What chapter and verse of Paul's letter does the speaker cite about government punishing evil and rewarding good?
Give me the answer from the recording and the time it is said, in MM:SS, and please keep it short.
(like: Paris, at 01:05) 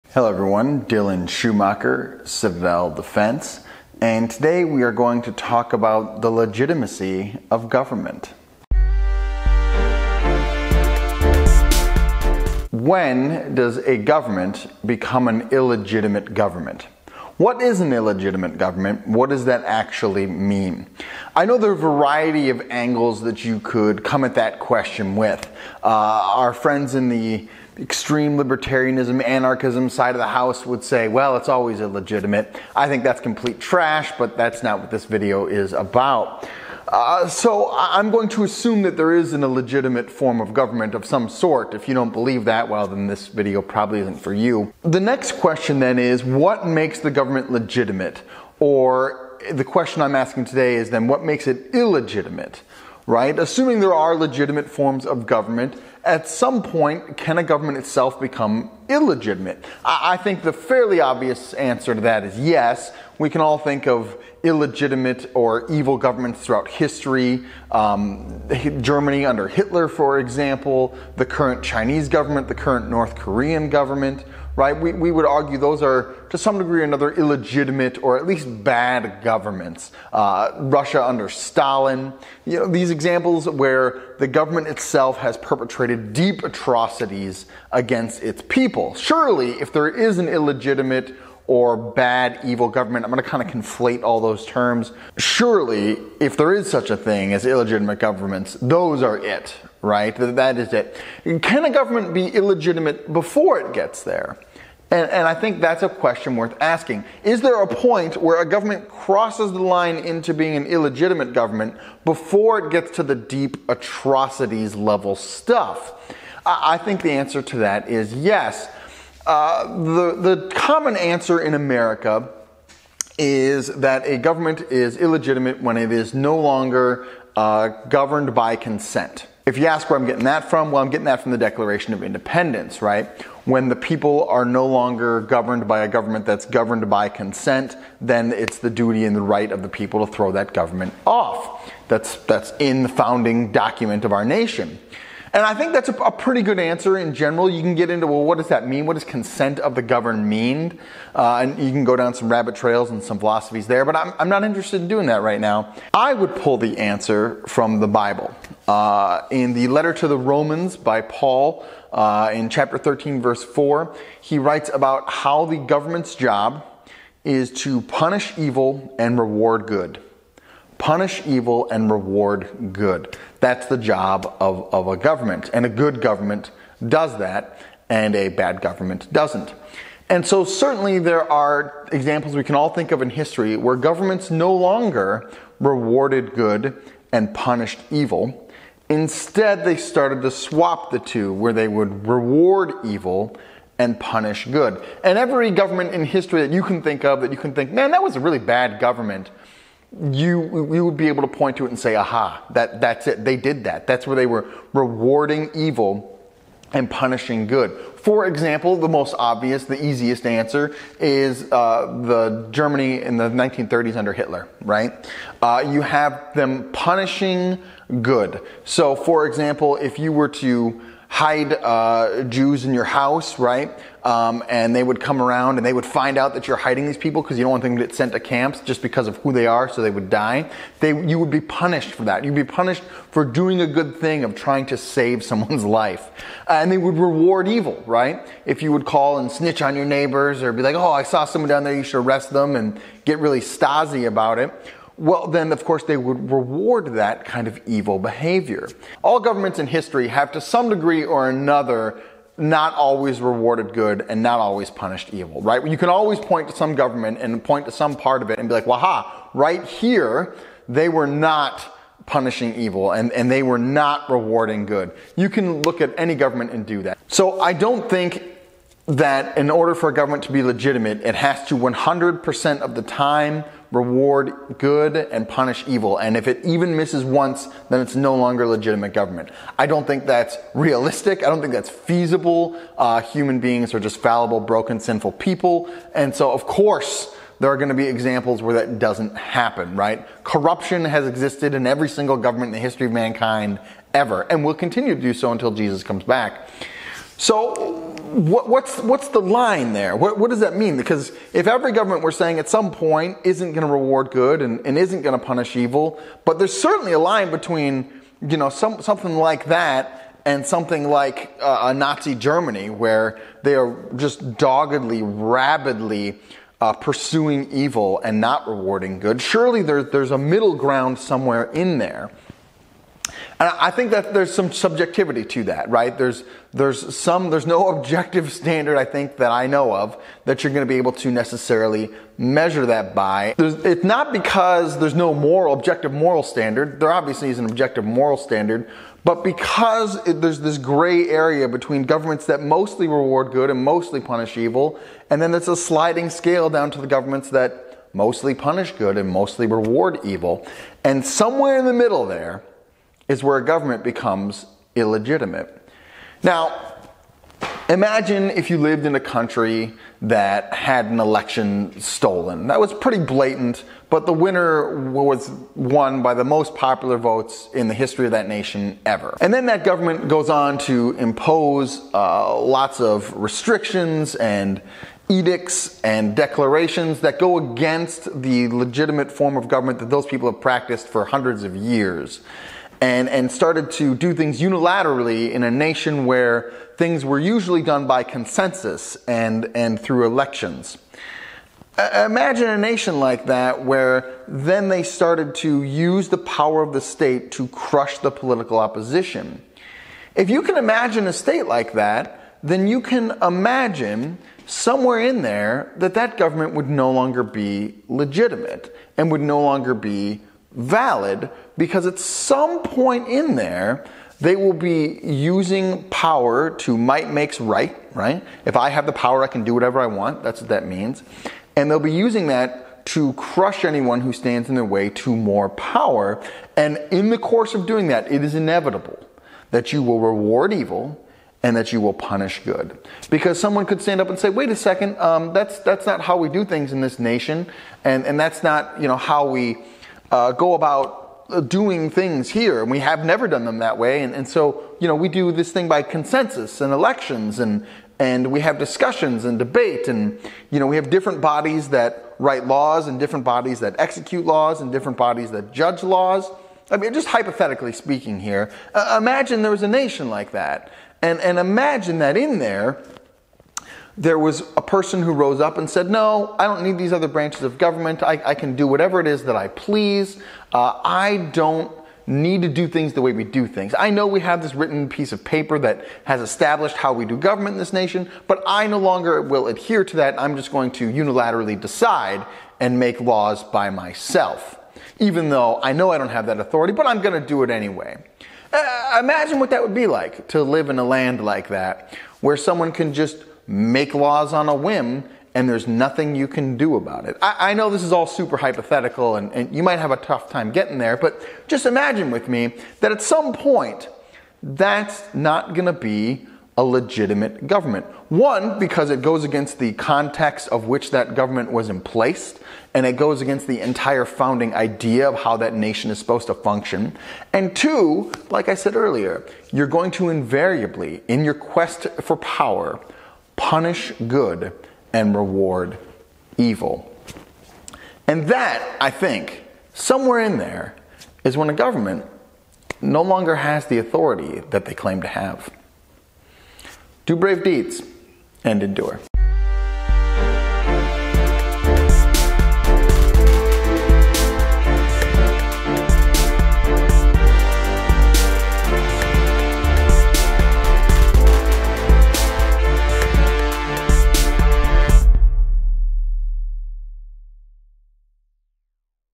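13:4, at 02:42.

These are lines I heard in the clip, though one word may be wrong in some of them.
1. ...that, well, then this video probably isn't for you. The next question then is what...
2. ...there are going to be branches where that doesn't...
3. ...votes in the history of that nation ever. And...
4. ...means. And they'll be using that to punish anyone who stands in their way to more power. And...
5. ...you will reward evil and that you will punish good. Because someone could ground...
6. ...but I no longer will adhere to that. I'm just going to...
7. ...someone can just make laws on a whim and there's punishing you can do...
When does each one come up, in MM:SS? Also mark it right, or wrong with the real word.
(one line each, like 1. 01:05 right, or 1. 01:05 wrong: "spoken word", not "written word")
1. 00:42 right
2. 04:47 wrong: "examples", not "branches"
3. 06:06 right
4. 07:00 wrong: "crush", not "punish"
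5. 07:09 wrong: "stand", not "ground"
6. 07:58 right
7. 08:12 wrong: "nothing", not "punishing".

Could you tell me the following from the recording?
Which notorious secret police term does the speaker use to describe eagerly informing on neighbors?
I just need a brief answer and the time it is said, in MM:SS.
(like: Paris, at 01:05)
Stasi, at 04:03.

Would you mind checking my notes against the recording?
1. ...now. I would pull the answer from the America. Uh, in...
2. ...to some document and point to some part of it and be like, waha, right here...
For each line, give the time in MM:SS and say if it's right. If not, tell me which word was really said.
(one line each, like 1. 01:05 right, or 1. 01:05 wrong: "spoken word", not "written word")
1. 02:35 wrong: "Bible", not "America"
2. 04:16 wrong: "government", not "document".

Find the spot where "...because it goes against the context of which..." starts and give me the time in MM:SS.
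08:28.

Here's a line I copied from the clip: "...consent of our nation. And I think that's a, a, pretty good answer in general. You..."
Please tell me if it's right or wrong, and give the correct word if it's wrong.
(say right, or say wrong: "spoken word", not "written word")
wrong: "document", not "consent".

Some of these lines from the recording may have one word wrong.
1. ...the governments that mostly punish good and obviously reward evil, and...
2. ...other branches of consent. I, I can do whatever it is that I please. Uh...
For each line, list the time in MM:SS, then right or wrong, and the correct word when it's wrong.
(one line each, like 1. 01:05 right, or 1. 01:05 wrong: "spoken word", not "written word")
1. 05:46 wrong: "mostly", not "obviously"
2. 07:46 wrong: "government", not "consent".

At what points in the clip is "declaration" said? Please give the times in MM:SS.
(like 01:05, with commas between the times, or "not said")
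02:11, 06:16.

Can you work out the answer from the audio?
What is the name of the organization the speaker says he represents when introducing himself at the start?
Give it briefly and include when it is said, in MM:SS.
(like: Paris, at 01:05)
Citadel Defense, at 00:02.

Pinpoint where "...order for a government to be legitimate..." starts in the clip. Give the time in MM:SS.
04:29.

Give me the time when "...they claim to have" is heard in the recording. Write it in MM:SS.
08:54.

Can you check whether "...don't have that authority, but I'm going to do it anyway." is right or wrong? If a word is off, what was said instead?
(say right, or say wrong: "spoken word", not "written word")
right.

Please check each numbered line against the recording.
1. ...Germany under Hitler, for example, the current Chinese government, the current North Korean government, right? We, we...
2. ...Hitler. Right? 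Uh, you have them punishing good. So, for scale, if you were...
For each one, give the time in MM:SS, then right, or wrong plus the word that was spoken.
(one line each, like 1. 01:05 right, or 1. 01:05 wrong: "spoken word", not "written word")
1. 01:08 right
2. 03:34 wrong: "example", not "scale".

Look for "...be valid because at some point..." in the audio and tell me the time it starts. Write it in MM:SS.
06:49.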